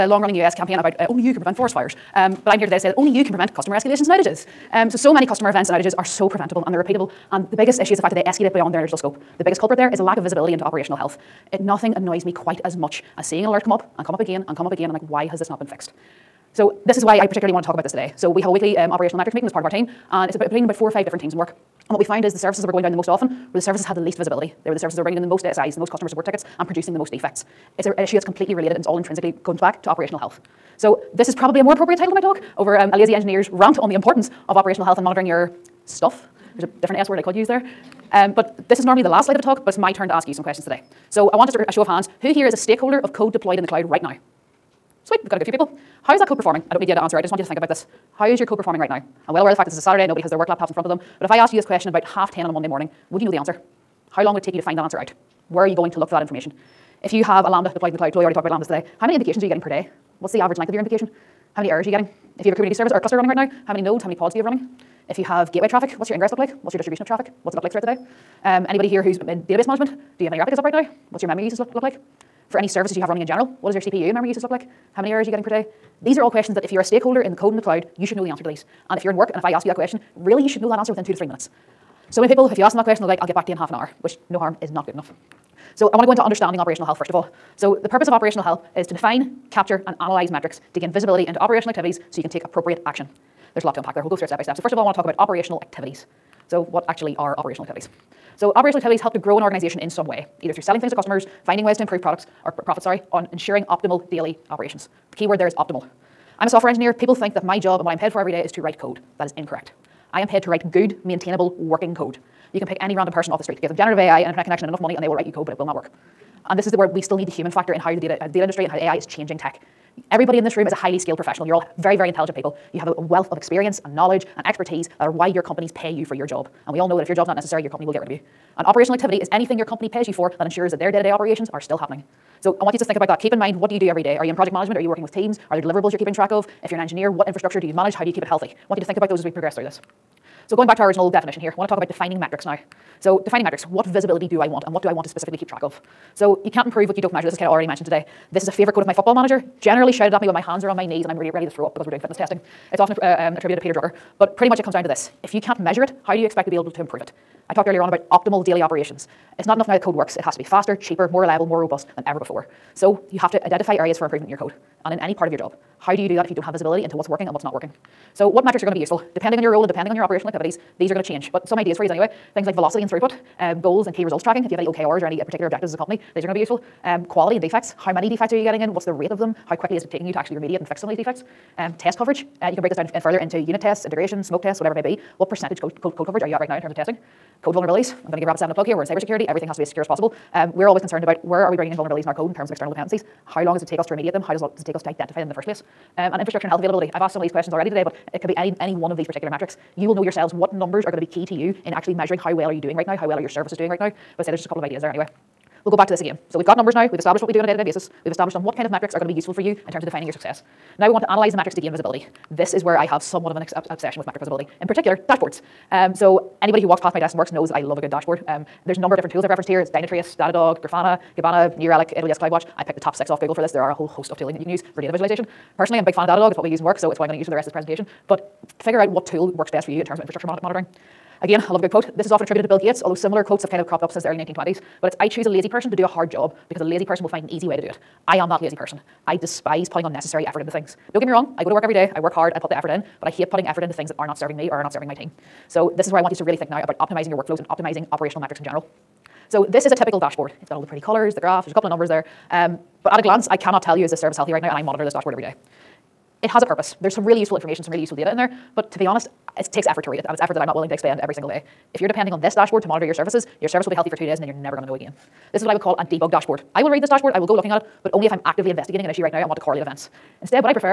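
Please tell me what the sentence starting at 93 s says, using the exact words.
There's a lot to unpack there.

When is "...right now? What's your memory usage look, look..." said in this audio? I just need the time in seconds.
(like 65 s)
70 s.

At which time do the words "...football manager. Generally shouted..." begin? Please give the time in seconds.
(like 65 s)
148 s.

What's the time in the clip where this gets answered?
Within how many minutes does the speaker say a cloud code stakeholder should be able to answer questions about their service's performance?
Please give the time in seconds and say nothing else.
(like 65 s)
81 s.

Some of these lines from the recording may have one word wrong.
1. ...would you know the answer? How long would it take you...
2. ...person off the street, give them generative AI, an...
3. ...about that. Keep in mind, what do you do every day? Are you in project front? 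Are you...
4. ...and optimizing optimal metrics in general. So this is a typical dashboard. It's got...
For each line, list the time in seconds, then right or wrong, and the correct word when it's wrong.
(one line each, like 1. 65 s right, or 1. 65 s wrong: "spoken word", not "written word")
1. 53 s right
2. 113 s right
3. 132 s wrong: "management", not "front"
4. 247 s wrong: "operational", not "optimal".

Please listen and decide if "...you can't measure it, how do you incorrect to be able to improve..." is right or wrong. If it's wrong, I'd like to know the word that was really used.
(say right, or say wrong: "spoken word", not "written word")
wrong: "expect", not "incorrect".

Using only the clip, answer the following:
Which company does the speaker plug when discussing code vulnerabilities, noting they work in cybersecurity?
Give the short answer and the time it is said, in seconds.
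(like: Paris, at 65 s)
Rapid7, at 188 s.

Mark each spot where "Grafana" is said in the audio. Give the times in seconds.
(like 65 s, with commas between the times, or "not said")
220 s.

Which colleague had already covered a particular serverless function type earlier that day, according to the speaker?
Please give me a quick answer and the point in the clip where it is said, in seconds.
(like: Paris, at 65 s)
Chloe, at 58 s.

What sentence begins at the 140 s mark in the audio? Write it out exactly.
So going back to our original definition here, I want to talk about defining metrics now.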